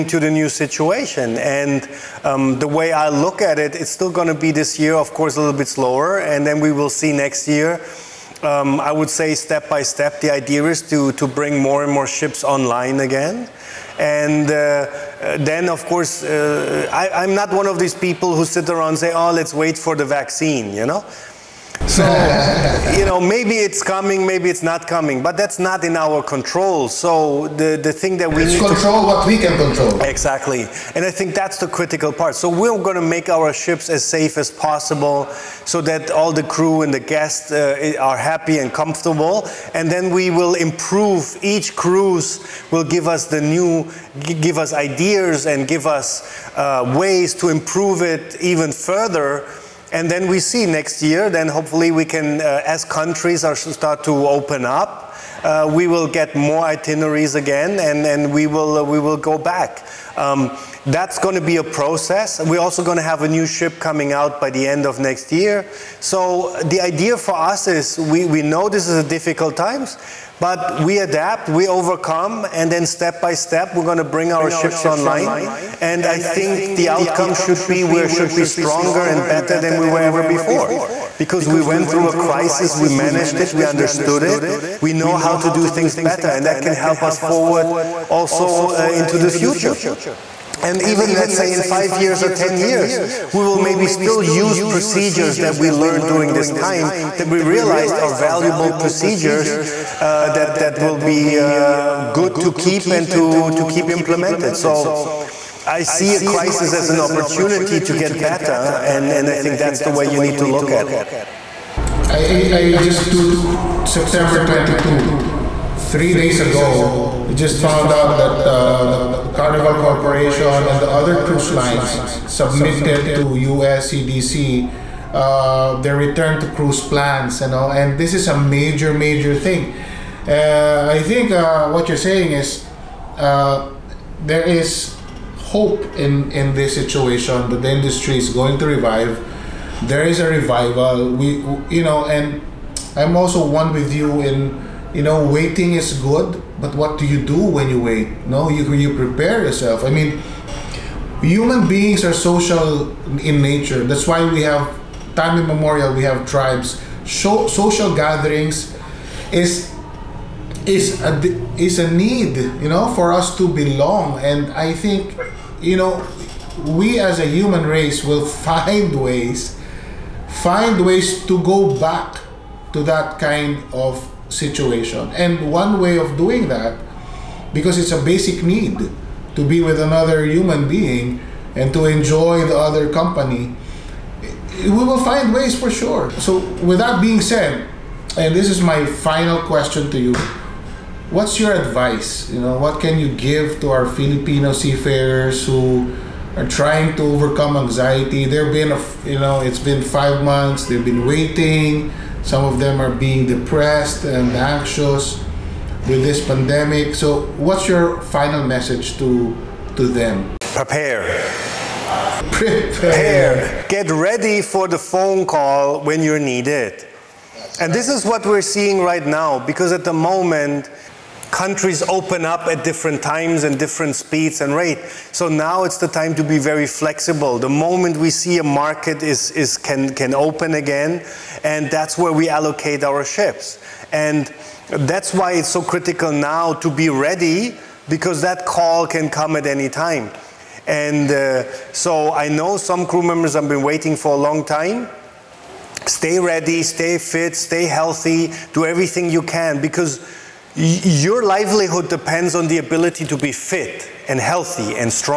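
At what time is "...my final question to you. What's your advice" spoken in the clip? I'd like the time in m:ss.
3:08.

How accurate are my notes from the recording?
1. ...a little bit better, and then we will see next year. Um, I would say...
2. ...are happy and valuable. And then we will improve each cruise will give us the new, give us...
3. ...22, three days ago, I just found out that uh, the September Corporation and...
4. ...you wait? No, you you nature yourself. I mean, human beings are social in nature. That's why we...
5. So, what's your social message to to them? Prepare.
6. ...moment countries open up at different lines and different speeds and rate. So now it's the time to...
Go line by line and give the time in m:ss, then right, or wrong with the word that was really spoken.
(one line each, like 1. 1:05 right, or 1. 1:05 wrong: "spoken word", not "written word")
1. 0:05 wrong: "slower", not "better"
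2. 0:37 wrong: "comfortable", not "valuable"
3. 1:54 wrong: "Carnival", not "September"
4. 2:27 wrong: "prepare", not "nature"
5. 3:26 wrong: "final", not "social"
6. 3:39 wrong: "times", not "lines".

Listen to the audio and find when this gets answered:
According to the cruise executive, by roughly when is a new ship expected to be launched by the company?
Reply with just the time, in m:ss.
1:04.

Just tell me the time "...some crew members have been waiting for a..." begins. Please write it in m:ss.
4:02.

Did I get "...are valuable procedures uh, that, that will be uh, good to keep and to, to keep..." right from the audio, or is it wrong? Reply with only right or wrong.
right.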